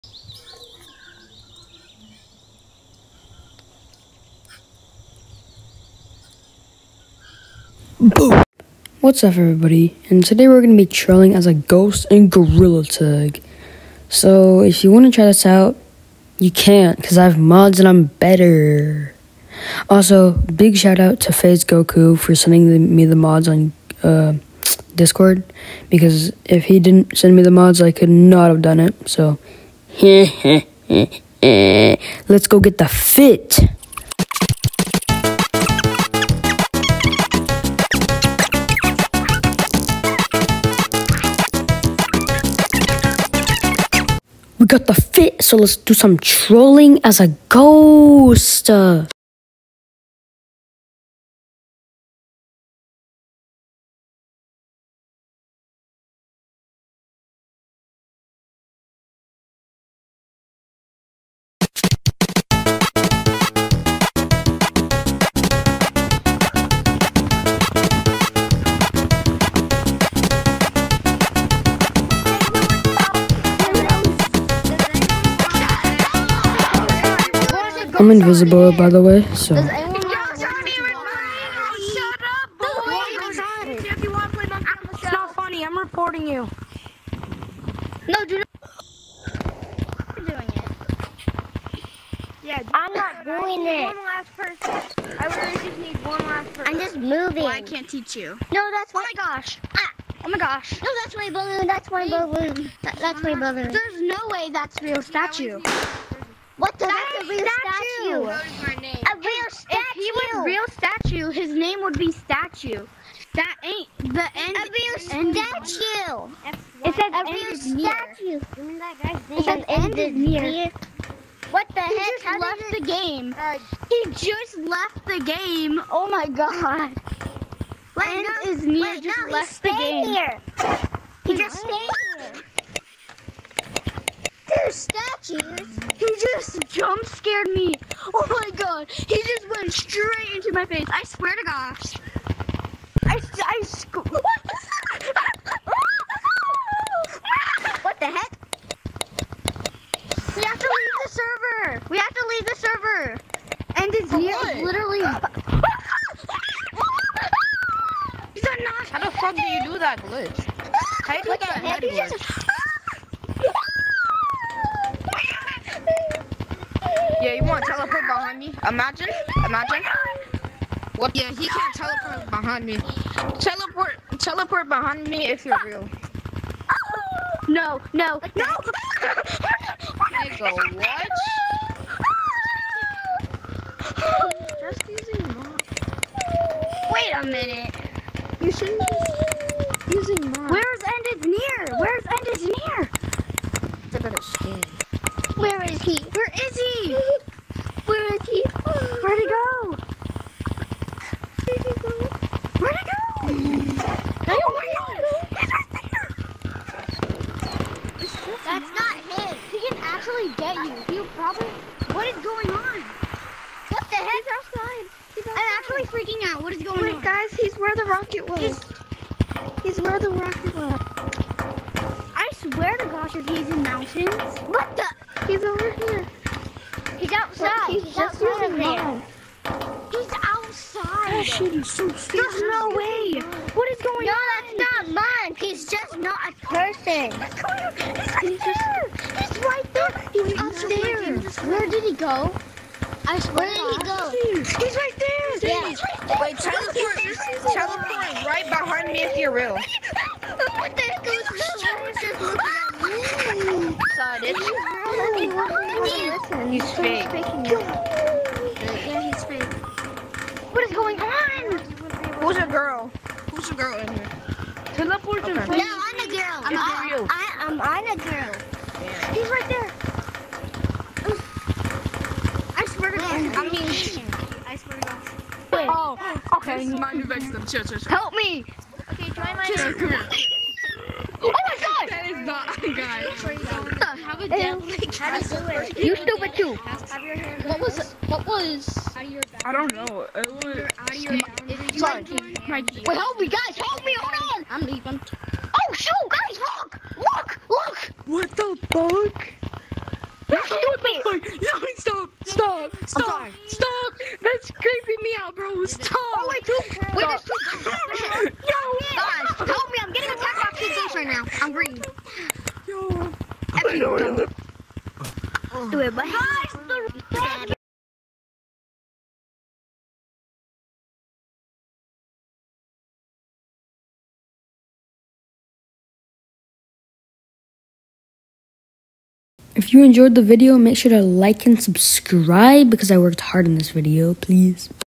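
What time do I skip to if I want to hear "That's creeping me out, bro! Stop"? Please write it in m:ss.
5:04.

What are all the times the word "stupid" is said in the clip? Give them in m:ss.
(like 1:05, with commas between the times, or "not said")
3:51, 4:45, 5:00.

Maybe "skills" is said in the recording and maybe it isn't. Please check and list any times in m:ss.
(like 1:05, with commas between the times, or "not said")
not said.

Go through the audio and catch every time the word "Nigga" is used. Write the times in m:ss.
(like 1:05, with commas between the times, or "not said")
2:58.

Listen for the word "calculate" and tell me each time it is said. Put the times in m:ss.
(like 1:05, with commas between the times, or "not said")
not said.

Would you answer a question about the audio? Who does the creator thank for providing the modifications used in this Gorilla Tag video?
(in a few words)
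FaZe Goku.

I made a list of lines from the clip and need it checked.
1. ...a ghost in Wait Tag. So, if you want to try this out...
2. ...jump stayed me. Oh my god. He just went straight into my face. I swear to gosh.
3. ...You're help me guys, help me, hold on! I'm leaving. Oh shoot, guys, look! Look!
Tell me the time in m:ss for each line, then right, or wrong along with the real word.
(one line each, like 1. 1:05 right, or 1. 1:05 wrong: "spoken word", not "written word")
1. 0:11 wrong: "Gorilla", not "Wait"
2. 2:16 wrong: "scared", not "stayed"
3. 4:51 right.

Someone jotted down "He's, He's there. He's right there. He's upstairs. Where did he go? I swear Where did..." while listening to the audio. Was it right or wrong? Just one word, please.
right.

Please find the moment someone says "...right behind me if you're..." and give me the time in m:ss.
4:08.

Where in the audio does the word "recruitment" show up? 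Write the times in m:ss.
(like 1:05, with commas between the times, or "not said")
not said.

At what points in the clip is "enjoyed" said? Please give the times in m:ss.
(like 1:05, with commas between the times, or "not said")
5:29.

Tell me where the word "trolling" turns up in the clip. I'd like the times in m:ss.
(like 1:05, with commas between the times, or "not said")
0:10, 0:46.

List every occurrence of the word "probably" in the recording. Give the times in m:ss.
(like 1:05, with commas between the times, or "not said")
3:31.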